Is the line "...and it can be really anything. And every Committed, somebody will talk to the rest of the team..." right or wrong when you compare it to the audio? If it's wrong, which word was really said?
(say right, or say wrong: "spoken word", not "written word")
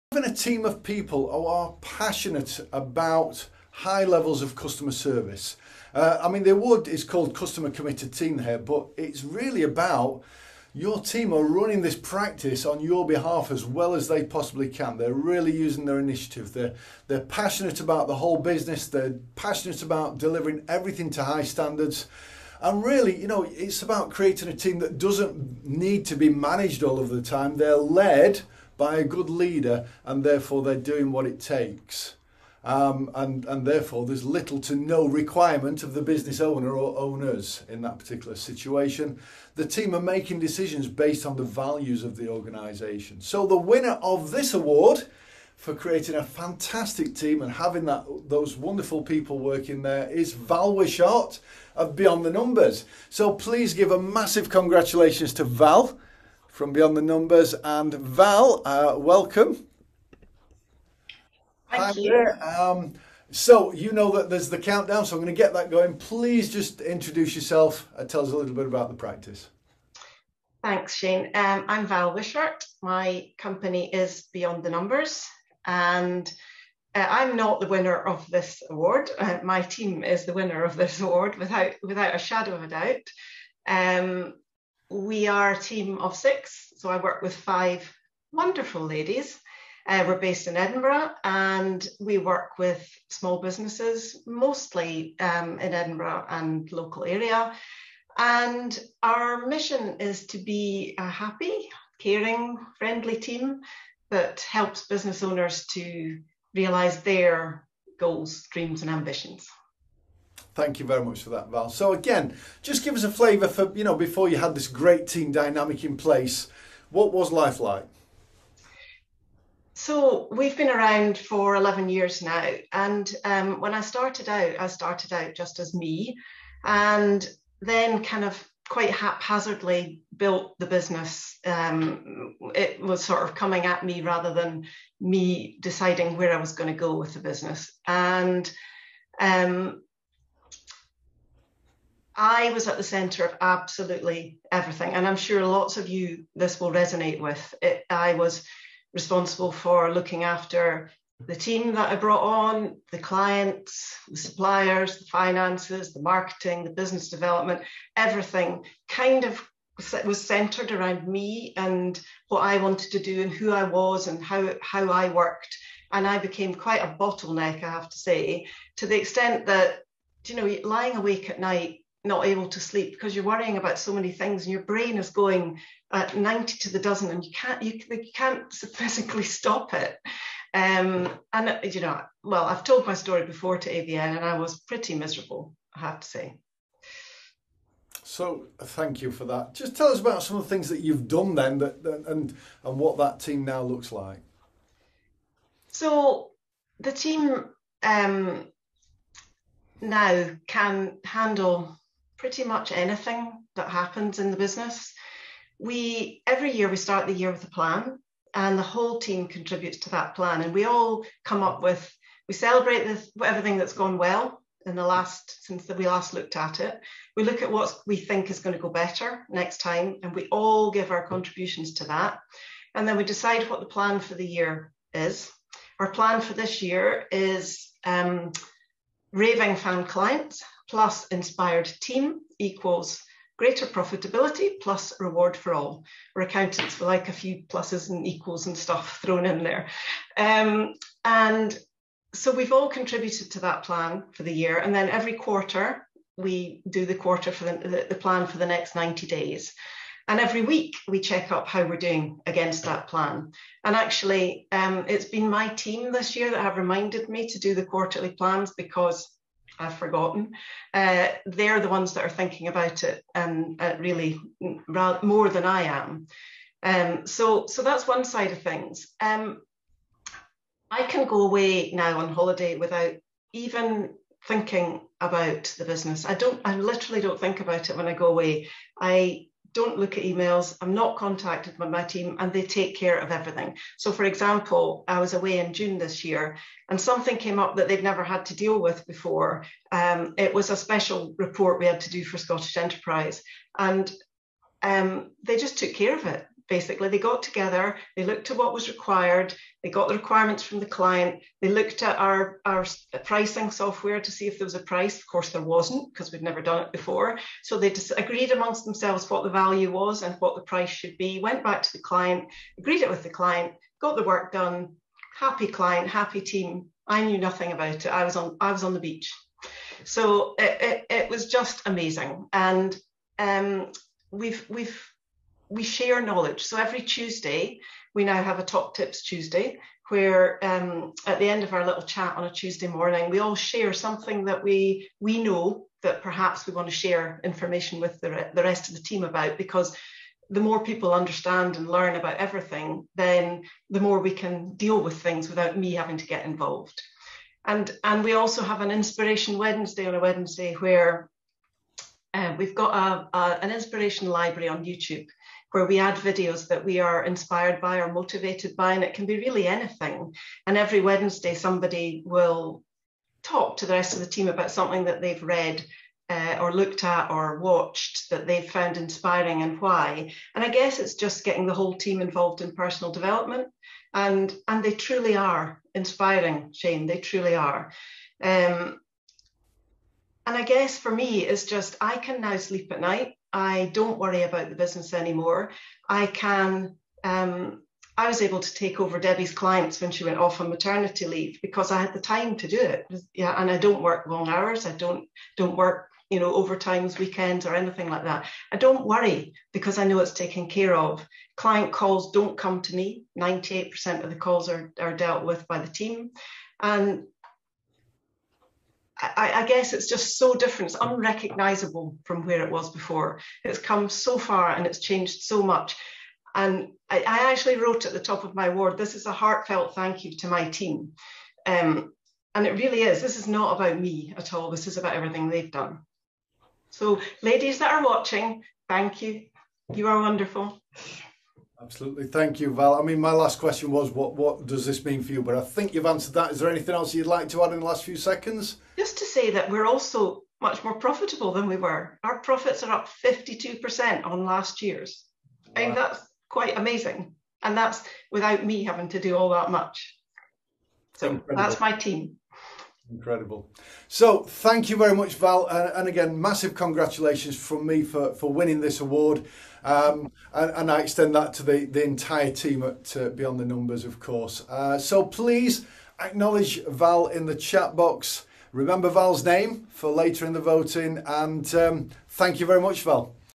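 wrong: "Wednesday", not "Committed".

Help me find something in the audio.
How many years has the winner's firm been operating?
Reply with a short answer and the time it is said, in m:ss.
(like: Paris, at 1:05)
11, at 2:01.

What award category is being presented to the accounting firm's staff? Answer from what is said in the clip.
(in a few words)
Customer Committed Team.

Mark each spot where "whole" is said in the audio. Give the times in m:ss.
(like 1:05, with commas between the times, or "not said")
0:18, 3:28, 6:11.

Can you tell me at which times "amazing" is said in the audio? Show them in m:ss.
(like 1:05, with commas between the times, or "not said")
5:21, 7:26.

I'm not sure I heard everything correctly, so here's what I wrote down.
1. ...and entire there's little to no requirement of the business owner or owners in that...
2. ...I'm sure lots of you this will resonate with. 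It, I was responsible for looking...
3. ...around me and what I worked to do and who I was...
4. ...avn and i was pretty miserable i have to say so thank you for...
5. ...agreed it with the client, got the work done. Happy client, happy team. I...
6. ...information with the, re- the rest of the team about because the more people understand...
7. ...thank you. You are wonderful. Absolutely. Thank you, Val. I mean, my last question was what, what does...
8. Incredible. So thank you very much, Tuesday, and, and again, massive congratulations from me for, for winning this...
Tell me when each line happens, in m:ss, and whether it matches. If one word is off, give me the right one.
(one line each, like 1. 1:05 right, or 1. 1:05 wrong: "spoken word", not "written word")
1. 0:33 wrong: "therefore", not "entire"
2. 2:25 right
3. 2:40 wrong: "wanted", not "worked"
4. 3:03 right
5. 5:12 right
6. 5:37 right
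7. 7:08 right
8. 7:32 wrong: "Val", not "Tuesday".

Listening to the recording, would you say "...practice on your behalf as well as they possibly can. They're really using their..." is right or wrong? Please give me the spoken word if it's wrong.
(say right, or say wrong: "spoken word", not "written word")
right.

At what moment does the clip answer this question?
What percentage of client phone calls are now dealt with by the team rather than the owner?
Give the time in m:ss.
6:43.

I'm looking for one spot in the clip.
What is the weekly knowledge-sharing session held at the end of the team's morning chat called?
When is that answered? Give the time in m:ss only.
5:28.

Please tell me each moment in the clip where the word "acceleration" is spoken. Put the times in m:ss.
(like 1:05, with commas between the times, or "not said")
not said.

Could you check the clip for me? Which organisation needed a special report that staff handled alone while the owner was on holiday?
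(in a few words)
Scottish Enterprise.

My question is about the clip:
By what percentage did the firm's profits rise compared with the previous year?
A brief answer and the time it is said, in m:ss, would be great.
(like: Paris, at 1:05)
52%, at 7:23.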